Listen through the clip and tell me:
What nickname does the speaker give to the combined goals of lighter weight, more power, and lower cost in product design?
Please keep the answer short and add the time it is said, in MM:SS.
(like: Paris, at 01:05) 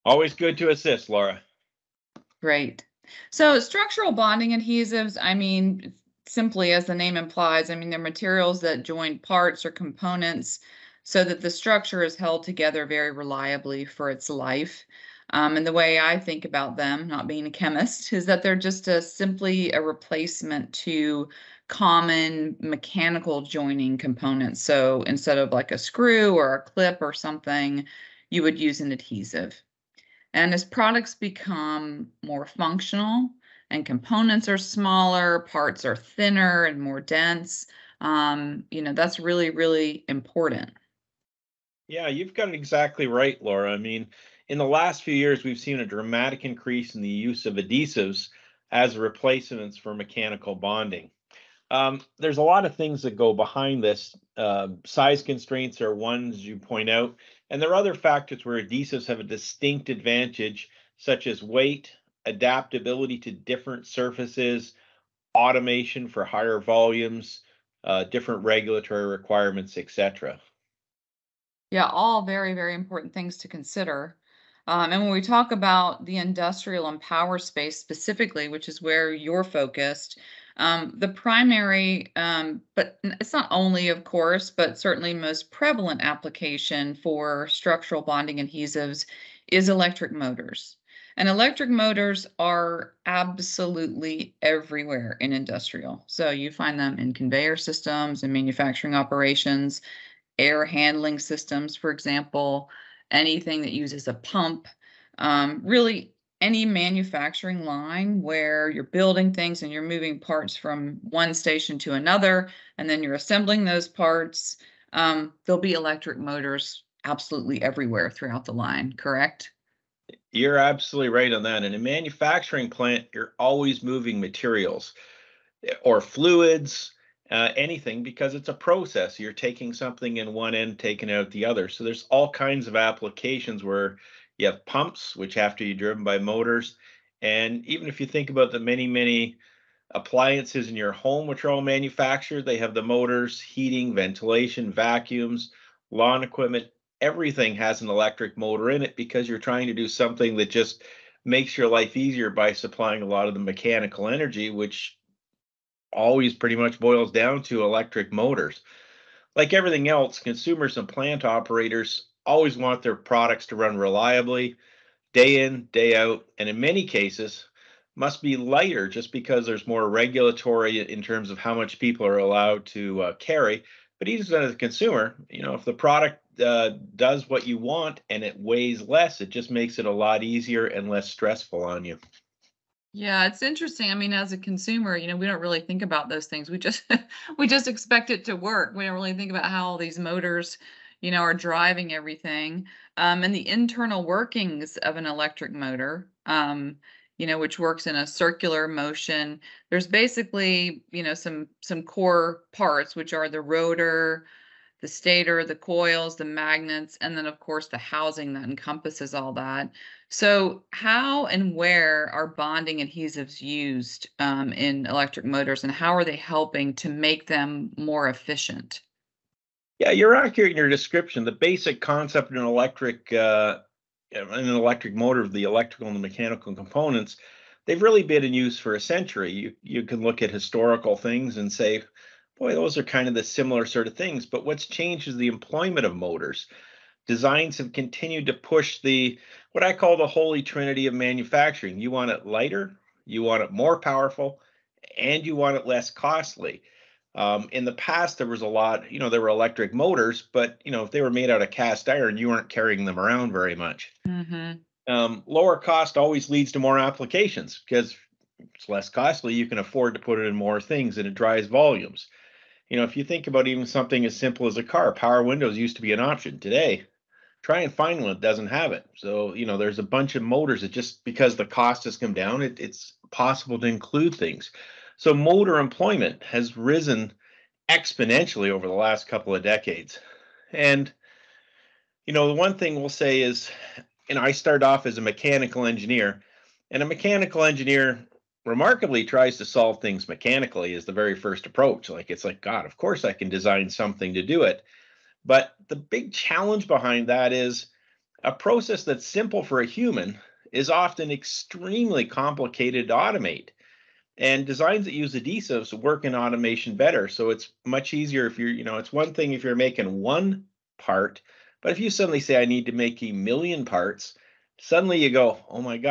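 Holy trinity of manufacturing, at 04:00.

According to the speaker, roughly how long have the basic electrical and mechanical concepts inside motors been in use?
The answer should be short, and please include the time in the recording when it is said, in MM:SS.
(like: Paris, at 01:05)
A century, at 03:48.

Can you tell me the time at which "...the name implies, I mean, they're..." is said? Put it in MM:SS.
00:06.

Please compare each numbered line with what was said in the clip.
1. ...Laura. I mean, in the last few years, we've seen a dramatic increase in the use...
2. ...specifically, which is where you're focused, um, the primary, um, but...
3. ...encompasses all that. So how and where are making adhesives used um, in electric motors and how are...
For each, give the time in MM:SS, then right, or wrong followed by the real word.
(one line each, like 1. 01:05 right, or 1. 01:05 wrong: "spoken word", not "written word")
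1. 00:43 right
2. 01:17 right
3. 03:28 wrong: "bonding", not "making".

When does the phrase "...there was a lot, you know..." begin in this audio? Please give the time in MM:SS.
04:08.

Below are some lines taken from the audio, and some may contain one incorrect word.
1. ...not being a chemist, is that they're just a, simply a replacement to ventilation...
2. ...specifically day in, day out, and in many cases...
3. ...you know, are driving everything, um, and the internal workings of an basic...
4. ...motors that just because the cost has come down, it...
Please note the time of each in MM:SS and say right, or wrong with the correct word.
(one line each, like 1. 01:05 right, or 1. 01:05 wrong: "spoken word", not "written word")
1. 00:17 wrong: "common", not "ventilation"
2. 02:43 wrong: "reliably", not "specifically"
3. 03:11 wrong: "electric", not "basic"
4. 04:30 right.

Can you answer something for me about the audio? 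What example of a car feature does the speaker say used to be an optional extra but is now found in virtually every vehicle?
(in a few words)
Power windows.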